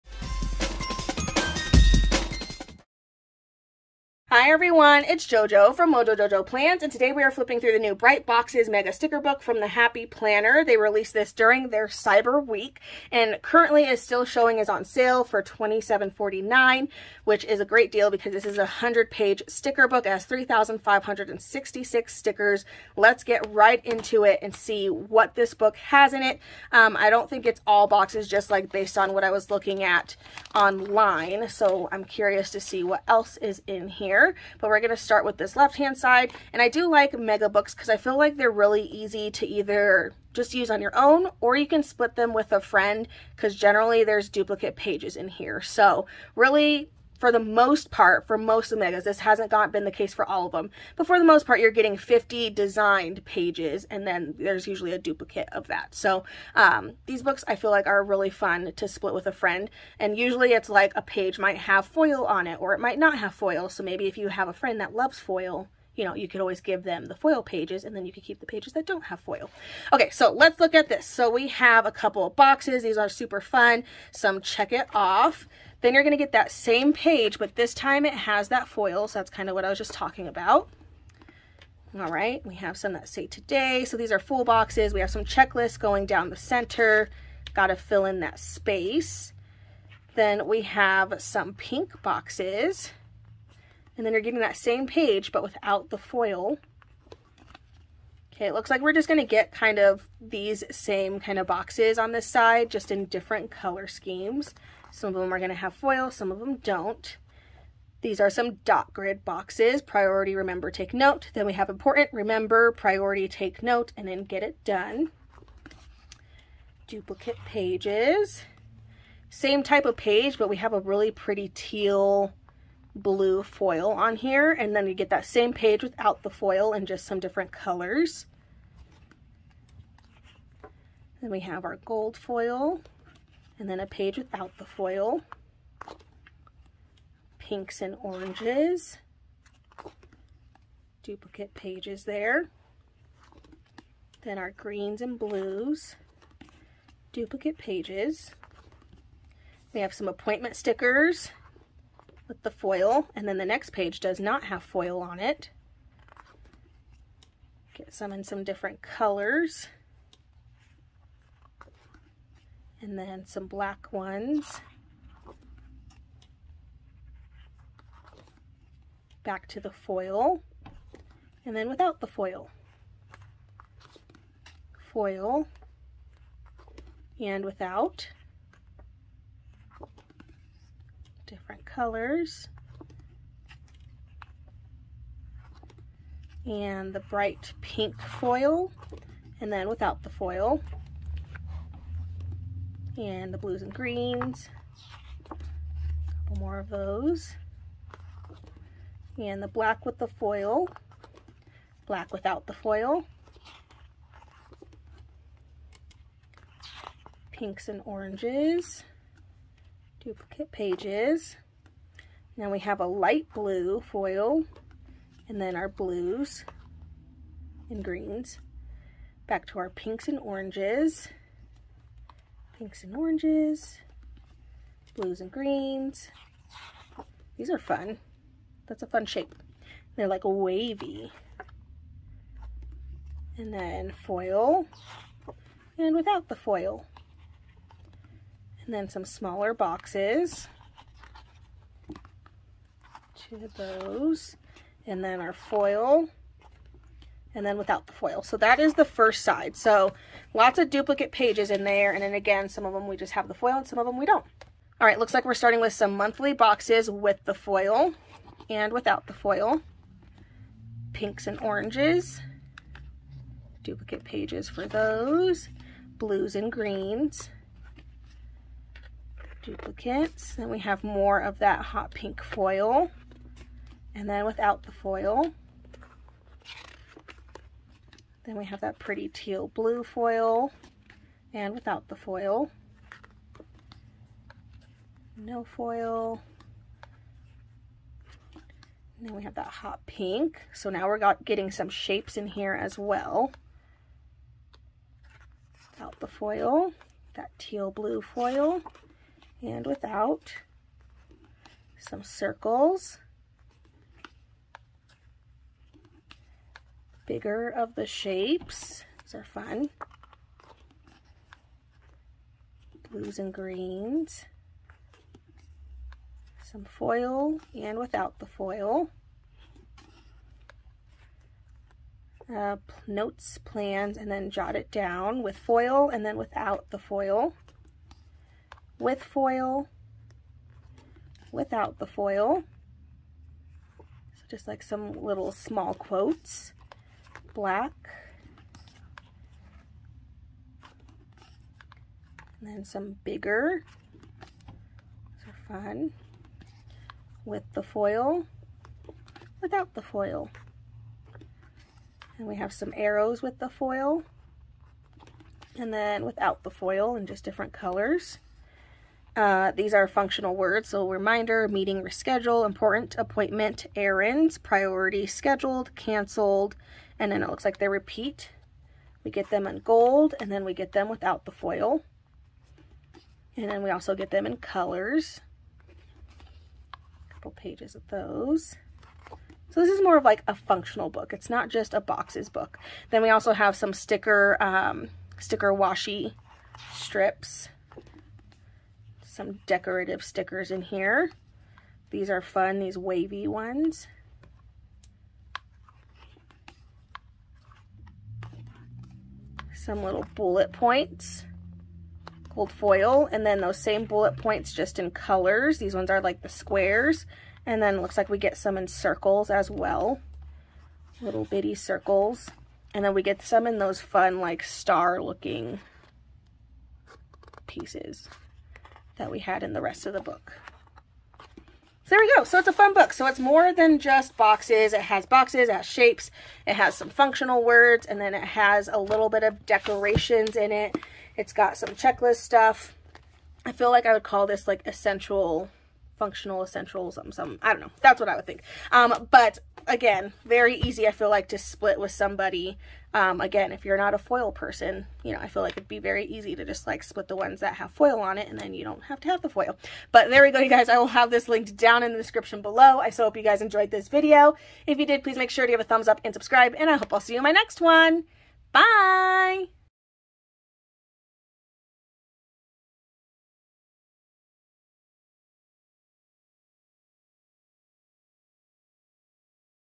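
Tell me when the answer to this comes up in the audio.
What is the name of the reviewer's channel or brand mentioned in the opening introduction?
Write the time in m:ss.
0:05.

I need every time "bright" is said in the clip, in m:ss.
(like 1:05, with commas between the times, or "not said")
0:07, 3:07.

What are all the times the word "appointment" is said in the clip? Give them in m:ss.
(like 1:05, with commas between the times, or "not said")
2:30, 6:02.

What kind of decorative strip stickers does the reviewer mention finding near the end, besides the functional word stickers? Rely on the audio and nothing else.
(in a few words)
sticker washi strips.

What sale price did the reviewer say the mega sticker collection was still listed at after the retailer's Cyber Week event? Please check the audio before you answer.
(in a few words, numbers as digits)
$27.49.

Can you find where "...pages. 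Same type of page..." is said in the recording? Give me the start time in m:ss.
1:57.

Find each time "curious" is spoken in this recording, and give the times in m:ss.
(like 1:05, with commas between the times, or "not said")
0:32.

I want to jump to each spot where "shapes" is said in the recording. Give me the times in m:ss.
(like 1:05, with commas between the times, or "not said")
3:49, 4:51, 5:07, 7:05.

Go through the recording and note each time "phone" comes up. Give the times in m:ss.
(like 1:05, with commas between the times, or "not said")
not said.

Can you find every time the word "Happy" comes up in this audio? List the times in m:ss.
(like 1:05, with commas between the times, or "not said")
0:09.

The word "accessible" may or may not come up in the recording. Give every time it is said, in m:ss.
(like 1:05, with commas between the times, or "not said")
not said.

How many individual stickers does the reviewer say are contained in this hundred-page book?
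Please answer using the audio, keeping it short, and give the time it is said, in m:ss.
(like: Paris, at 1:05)
3,566, at 0:20.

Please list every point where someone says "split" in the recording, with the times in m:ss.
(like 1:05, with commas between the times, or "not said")
0:41, 0:58, 7:21, 7:26.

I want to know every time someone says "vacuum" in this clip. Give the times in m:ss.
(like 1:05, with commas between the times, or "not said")
not said.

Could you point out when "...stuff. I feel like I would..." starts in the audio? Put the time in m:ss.
7:12.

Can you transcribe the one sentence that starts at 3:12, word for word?
And the blues and greens, a couple more of those.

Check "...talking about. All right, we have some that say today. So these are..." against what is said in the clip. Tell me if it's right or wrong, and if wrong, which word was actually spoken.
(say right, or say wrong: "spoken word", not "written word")
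right.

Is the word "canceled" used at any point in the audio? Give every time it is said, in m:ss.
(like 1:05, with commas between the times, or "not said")
6:05.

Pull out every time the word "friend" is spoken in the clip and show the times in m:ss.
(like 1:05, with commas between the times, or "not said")
0:42, 0:59, 1:04.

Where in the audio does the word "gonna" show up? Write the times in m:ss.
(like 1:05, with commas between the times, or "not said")
1:39, 1:45.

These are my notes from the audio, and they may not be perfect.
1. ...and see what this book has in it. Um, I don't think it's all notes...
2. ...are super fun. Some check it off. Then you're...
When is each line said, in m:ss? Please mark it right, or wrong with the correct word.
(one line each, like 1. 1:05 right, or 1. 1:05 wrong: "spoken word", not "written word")
1. 0:24 wrong: "boxes", not "notes"
2. 1:12 right.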